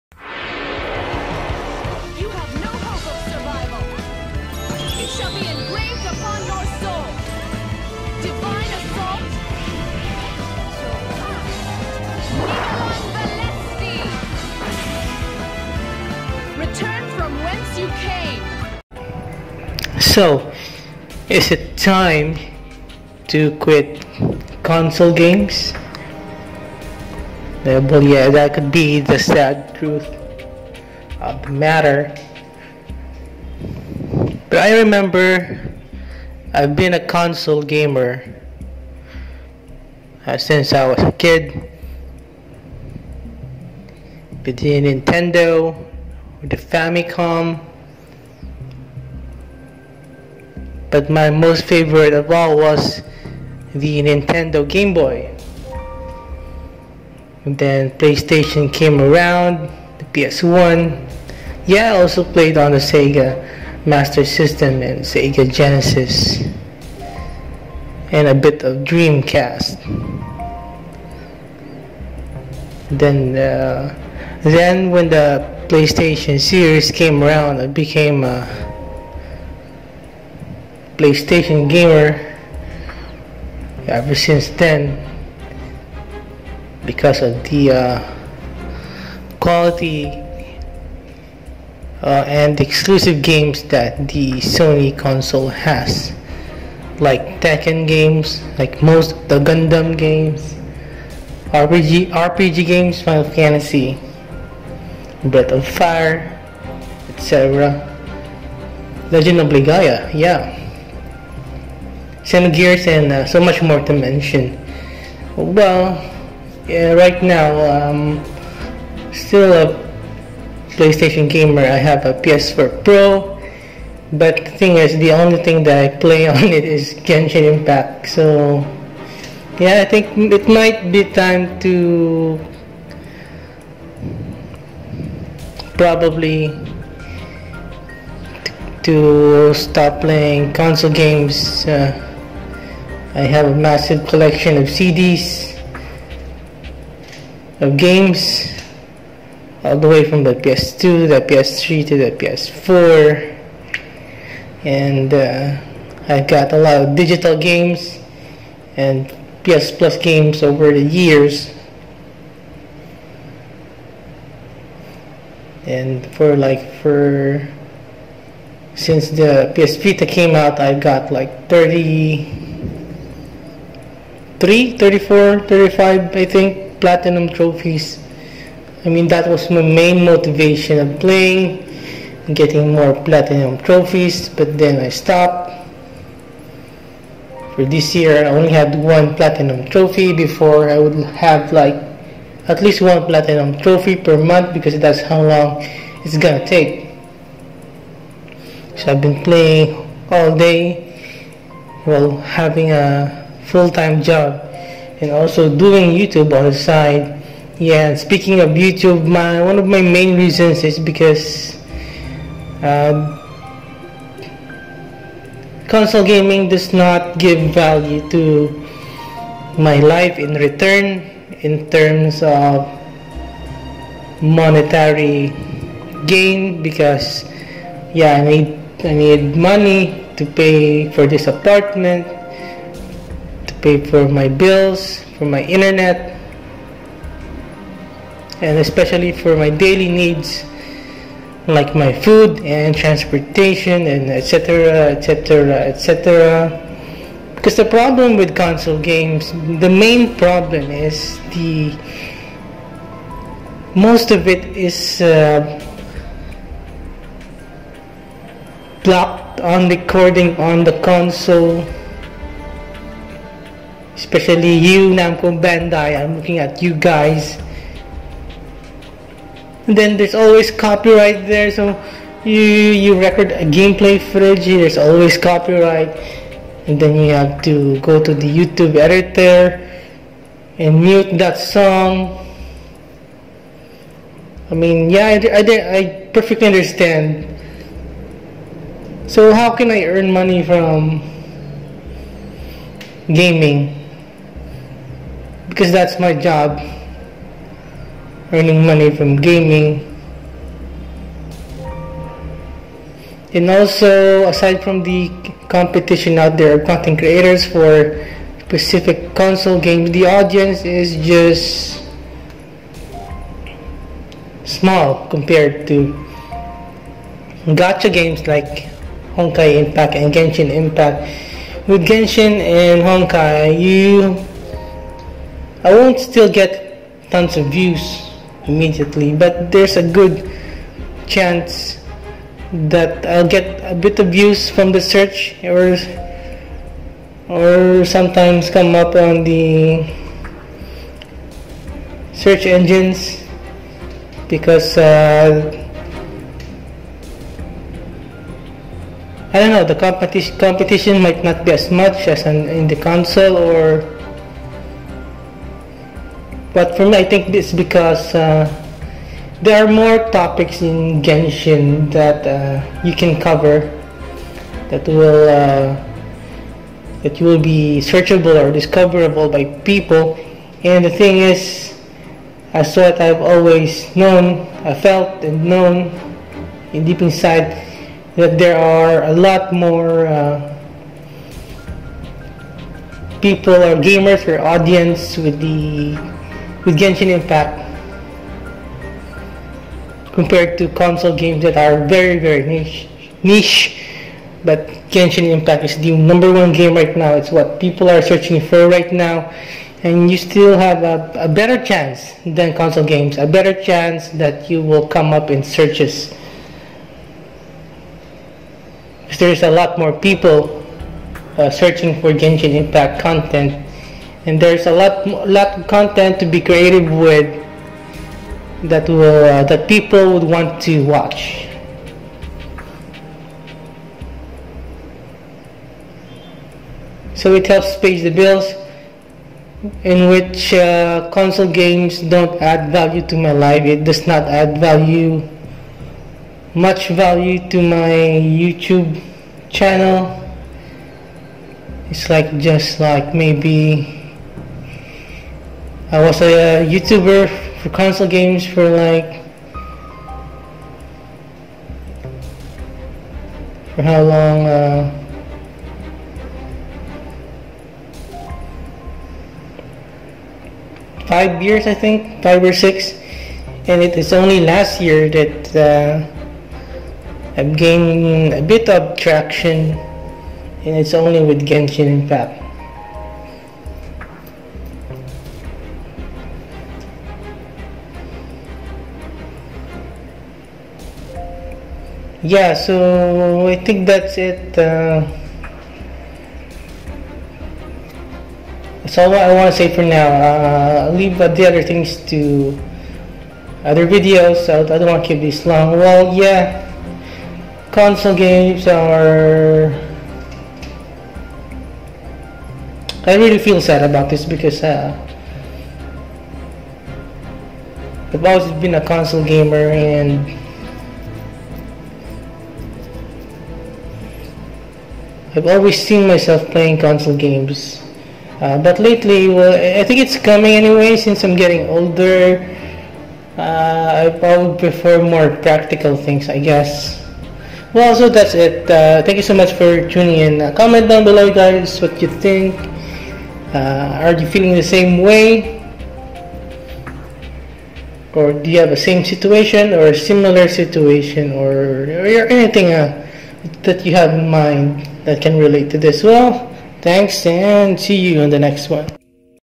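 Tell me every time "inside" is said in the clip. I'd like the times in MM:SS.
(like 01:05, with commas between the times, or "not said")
06:17.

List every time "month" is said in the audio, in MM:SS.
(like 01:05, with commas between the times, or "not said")
03:14.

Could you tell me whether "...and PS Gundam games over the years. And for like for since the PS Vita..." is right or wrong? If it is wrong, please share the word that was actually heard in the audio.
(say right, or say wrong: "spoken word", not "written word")
wrong: "Plus", not "Gundam".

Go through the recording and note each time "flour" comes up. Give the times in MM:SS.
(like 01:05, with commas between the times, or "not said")
not said.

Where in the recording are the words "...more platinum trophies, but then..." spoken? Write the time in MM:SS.
03:02.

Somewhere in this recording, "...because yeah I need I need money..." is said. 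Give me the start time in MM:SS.
03:46.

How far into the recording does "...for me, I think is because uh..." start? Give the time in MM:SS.
05:56.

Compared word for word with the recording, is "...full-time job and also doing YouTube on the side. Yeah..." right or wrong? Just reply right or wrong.
right.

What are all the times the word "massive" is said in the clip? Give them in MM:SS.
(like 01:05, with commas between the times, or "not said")
02:23.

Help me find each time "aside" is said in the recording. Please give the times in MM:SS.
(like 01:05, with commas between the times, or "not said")
05:04.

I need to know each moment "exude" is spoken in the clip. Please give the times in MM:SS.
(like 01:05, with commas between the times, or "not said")
not said.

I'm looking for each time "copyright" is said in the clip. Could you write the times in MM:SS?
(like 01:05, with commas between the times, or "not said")
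04:30, 04:35.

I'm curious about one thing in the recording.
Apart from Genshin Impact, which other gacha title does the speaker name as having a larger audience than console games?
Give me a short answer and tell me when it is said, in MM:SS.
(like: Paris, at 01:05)
Honkai Impact, at 05:19.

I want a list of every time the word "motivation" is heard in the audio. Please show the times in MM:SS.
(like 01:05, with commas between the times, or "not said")
03:00.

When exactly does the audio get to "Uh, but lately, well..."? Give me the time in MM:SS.
08:38.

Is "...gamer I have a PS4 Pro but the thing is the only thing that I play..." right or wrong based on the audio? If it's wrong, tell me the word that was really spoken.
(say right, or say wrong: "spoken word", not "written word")
right.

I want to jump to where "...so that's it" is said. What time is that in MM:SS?
08:47.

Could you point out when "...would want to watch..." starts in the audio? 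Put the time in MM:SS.
07:00.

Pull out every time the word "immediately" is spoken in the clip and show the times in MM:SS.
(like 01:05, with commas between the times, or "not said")
05:28.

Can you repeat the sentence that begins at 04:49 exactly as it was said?
So how can I earn money from gaming?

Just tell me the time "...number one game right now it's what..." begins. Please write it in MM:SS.
06:35.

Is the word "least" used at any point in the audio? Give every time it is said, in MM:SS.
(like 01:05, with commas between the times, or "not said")
03:12.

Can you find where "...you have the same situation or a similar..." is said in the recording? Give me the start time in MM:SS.
08:58.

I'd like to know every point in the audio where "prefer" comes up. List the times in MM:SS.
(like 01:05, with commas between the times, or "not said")
08:44.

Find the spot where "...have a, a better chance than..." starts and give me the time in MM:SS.
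06:40.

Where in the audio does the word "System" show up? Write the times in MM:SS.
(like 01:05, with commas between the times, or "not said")
01:04.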